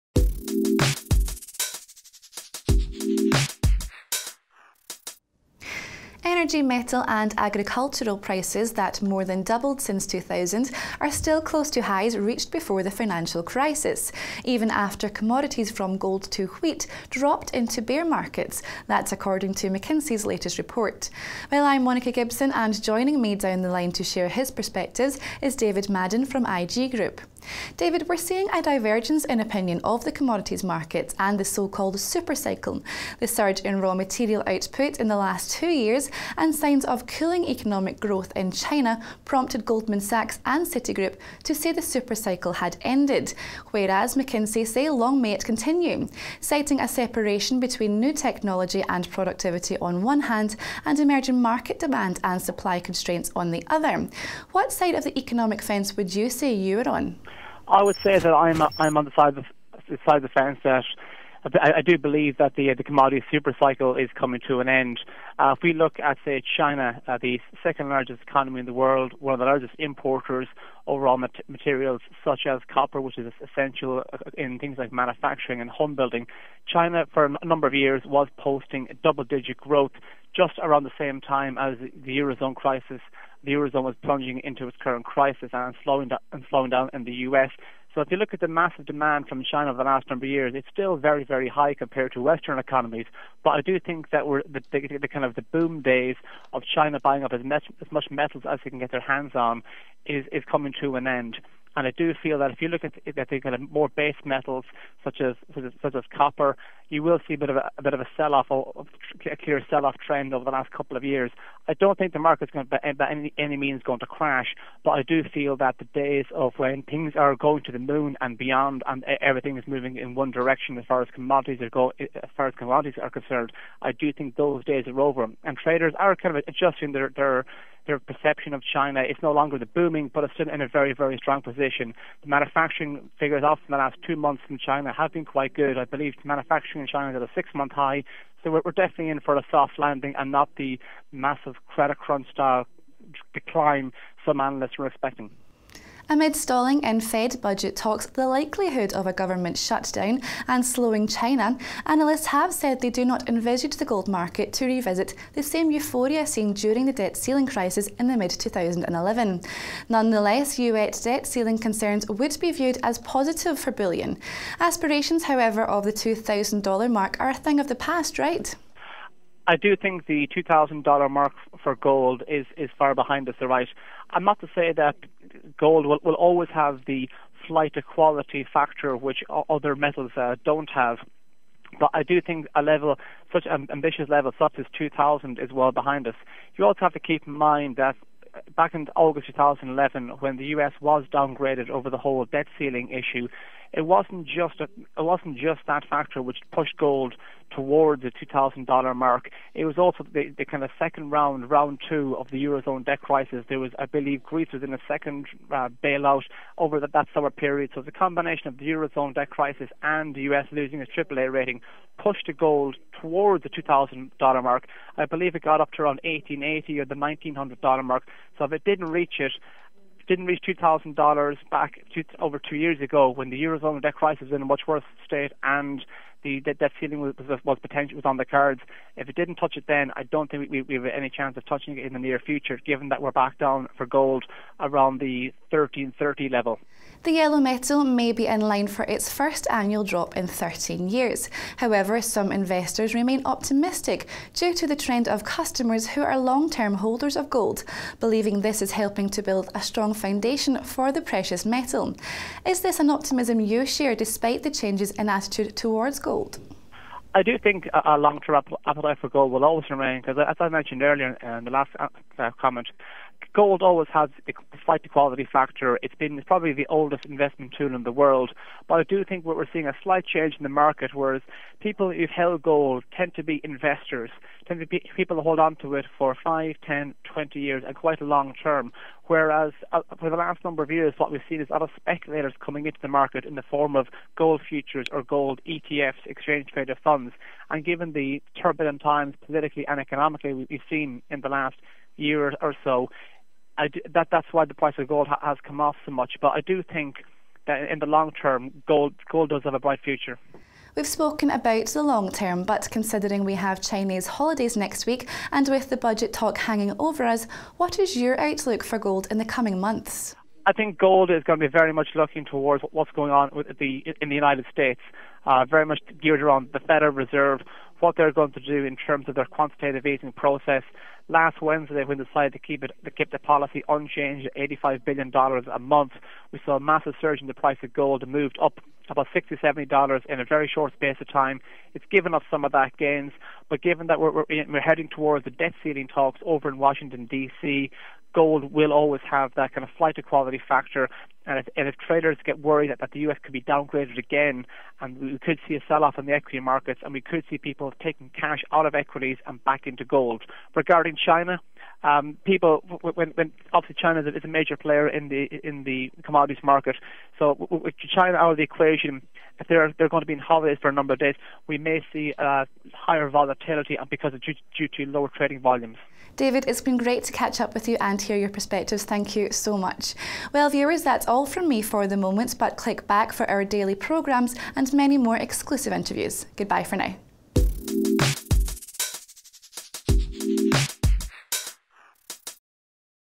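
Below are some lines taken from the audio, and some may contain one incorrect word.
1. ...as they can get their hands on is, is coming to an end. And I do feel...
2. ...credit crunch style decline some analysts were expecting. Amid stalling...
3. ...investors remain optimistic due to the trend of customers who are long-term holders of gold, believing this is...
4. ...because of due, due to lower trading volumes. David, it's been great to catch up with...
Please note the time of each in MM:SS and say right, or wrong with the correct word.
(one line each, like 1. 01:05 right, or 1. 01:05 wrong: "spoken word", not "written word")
1. 01:38 right
2. 02:21 right
3. 04:02 right
4. 06:03 right.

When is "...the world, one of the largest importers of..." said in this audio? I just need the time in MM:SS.
01:08.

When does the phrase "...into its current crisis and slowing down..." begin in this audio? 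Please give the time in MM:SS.
01:24.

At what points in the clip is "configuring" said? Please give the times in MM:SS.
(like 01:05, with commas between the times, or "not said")
not said.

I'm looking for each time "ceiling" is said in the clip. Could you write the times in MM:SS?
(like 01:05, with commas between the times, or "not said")
02:37, 02:41, 03:12, 03:46, 05:35.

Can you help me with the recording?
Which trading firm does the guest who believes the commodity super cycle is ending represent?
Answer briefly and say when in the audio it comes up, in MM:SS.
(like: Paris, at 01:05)
IG Group, at 00:26.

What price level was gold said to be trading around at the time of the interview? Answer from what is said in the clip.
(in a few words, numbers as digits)
1330.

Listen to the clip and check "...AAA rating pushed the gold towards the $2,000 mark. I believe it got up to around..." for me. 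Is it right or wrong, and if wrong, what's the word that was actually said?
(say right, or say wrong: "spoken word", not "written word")
right.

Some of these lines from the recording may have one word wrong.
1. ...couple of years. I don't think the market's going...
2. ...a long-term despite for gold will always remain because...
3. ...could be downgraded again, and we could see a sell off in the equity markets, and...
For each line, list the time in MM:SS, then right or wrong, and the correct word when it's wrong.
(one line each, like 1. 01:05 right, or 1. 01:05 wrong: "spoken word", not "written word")
1. 01:50 right
2. 04:17 wrong: "appetite", not "despite"
3. 05:43 right.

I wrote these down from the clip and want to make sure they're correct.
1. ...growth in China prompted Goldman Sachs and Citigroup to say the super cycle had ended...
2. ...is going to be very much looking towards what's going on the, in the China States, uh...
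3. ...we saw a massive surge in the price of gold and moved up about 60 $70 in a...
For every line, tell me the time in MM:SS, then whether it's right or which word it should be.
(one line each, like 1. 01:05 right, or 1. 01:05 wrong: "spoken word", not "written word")
1. 00:37 right
2. 05:11 wrong: "United", not "China"
3. 05:26 right.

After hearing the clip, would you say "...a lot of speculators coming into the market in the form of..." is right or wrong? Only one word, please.
right.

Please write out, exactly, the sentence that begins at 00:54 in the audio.
What side of the economic fence would you say you are on?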